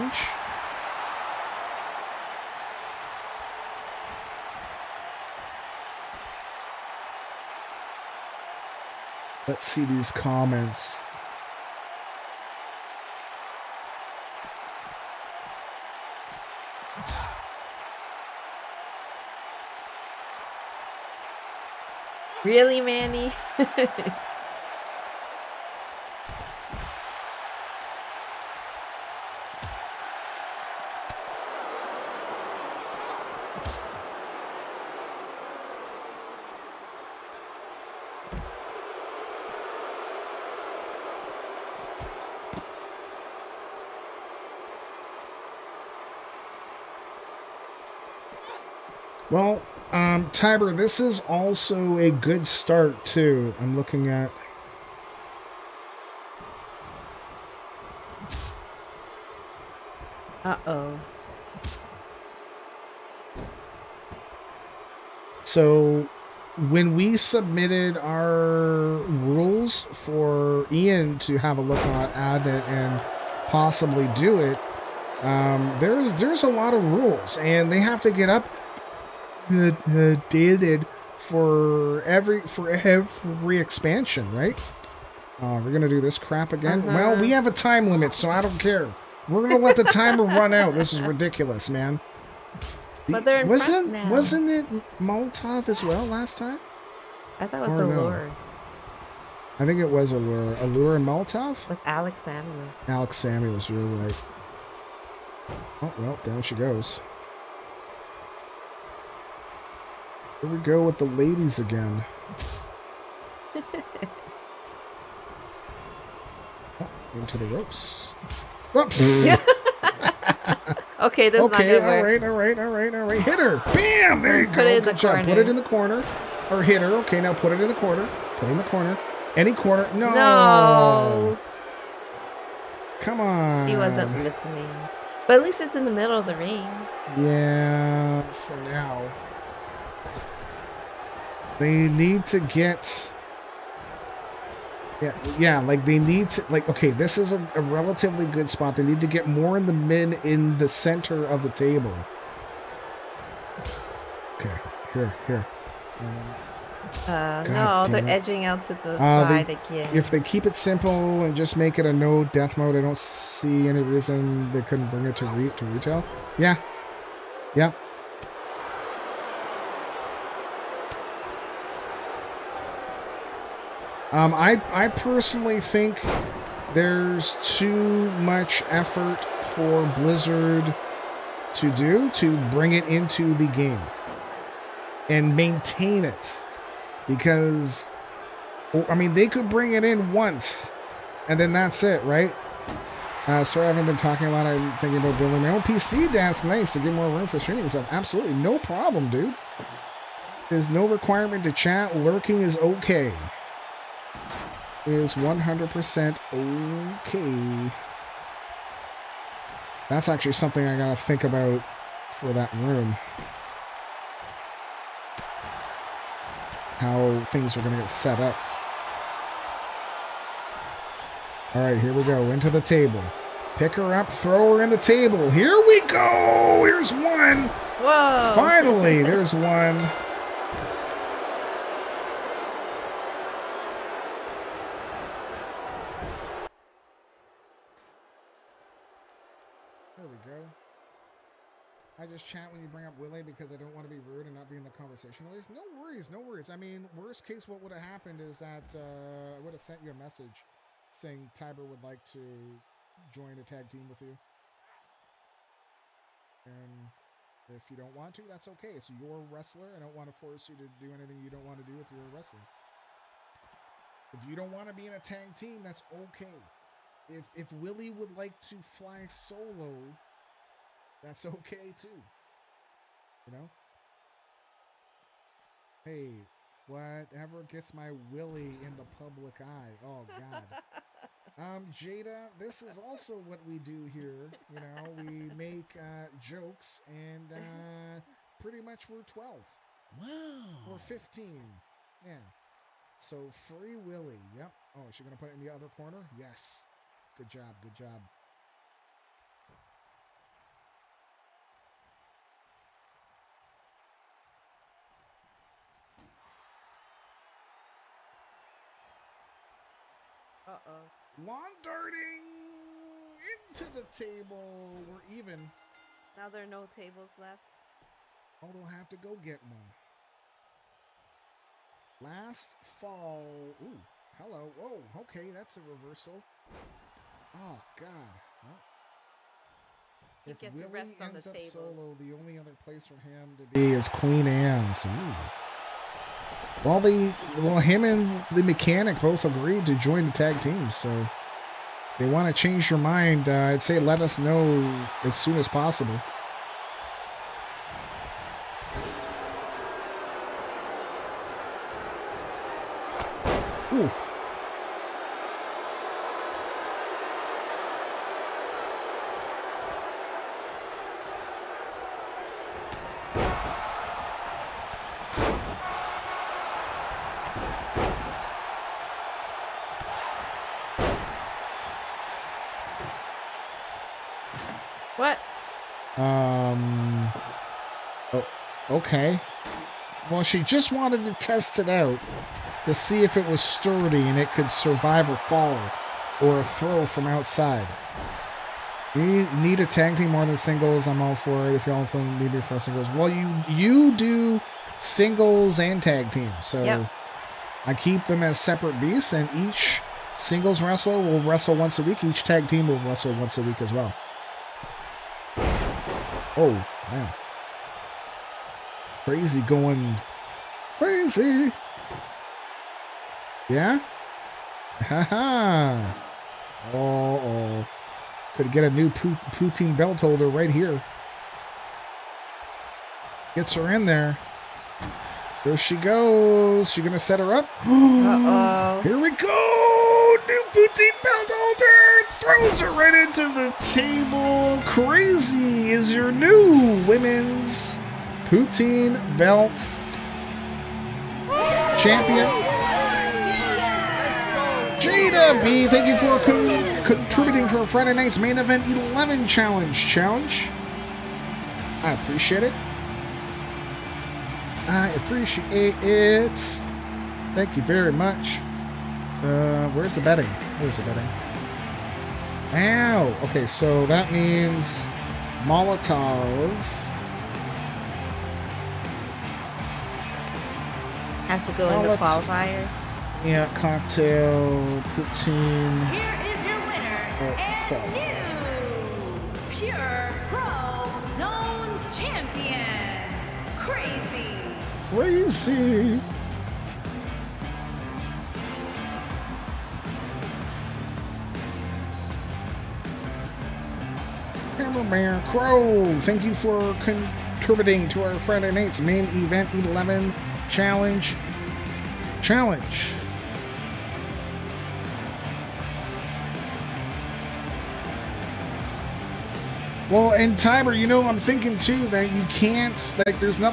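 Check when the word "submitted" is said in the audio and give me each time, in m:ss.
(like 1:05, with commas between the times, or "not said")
1:07.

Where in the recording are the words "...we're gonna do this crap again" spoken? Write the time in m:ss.
1:25.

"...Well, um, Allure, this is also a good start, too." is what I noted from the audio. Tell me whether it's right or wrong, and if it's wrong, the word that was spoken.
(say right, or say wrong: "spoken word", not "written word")
wrong: "Tiber", not "Allure".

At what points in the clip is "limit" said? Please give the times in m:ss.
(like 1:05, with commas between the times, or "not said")
1:27.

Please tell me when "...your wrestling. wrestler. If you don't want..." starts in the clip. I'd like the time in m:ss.
4:21.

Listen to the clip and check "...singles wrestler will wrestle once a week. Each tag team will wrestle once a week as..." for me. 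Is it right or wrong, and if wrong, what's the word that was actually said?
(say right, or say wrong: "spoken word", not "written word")
right.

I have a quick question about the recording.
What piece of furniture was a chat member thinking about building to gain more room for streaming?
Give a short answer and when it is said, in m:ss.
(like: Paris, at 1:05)
PC desk, at 3:15.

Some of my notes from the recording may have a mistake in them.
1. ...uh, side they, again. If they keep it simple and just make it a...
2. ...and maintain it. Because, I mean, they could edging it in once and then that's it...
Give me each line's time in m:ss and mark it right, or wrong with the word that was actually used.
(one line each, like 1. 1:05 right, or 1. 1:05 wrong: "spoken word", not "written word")
1. 2:38 right
2. 3:05 wrong: "bring", not "edging".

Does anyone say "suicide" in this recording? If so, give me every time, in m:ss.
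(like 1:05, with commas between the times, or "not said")
not said.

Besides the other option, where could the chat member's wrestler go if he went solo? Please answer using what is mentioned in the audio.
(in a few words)
Queen Anne's.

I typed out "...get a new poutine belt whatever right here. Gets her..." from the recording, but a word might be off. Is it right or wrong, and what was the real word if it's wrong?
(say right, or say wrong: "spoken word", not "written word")
wrong: "holder", not "whatever".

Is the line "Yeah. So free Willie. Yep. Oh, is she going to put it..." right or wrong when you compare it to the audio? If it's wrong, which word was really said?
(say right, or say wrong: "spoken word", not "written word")
right.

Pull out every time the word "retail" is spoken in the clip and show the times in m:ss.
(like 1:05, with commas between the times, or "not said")
2:45.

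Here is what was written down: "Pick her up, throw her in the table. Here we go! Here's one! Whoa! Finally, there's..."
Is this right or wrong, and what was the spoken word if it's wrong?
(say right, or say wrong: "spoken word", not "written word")
right.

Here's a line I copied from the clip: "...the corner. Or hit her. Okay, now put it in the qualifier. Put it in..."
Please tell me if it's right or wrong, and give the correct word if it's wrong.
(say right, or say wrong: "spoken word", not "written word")
wrong: "corner", not "qualifier".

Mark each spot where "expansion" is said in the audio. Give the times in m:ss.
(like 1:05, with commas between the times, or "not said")
1:23.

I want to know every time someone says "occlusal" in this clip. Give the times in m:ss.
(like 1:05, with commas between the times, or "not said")
not said.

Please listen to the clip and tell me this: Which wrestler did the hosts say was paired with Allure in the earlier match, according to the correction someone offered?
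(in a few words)
Alex Samuels.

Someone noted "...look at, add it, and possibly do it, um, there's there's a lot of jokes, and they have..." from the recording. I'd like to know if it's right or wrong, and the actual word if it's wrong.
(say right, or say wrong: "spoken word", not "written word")
wrong: "rules", not "jokes".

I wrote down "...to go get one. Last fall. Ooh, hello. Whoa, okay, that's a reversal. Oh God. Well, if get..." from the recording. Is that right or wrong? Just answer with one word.
right.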